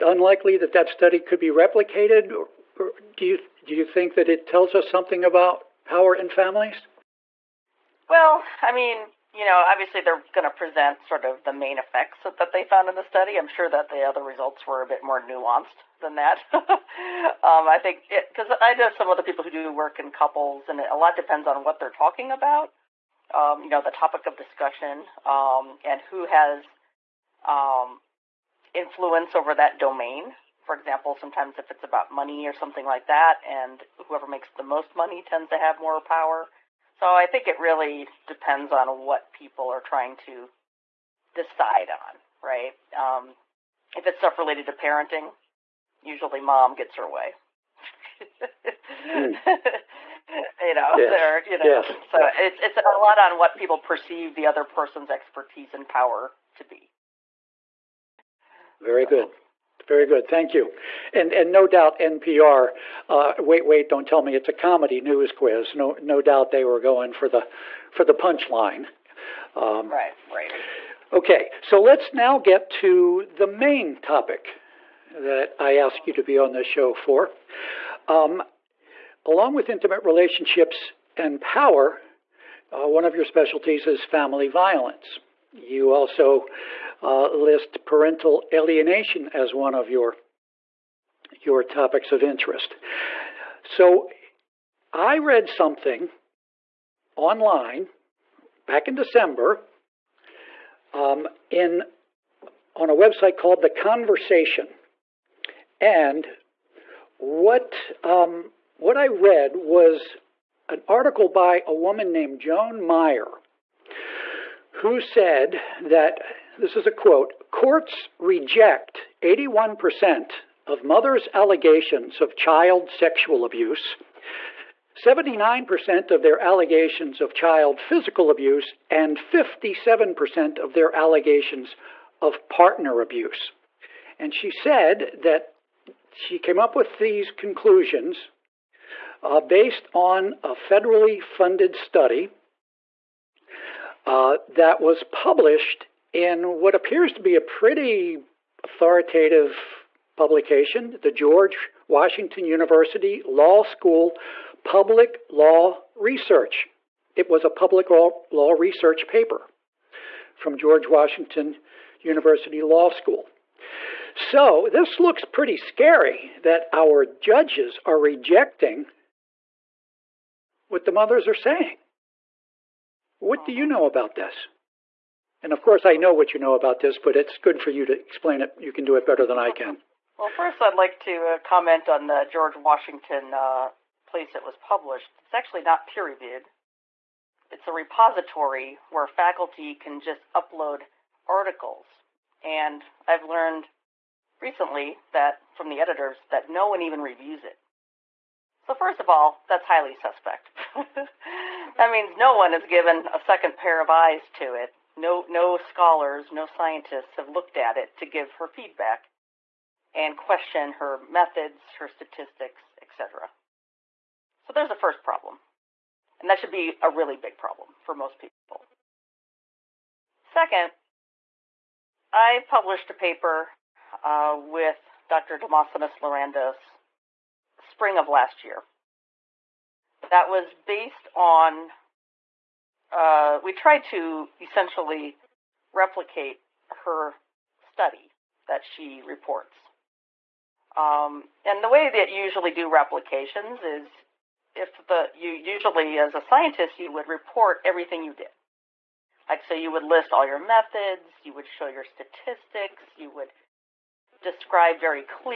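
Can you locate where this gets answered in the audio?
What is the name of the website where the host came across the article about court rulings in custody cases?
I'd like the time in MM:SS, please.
01:43.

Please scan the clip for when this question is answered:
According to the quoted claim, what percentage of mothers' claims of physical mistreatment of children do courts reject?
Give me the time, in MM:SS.
02:04.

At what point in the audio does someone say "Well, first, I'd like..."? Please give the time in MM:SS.
03:00.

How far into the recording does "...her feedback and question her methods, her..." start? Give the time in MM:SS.
03:28.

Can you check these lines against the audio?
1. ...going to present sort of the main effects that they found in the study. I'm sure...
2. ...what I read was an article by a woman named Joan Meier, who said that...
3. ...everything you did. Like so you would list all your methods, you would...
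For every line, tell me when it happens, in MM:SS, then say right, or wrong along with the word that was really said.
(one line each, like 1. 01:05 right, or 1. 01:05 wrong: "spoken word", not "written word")
1. 00:10 right
2. 01:48 right
3. 04:07 right.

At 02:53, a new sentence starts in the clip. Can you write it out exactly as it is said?
What do you know about this?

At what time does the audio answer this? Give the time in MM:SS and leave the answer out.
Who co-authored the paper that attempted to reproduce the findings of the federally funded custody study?
03:45.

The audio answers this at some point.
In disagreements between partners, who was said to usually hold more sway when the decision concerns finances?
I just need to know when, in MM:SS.
00:34.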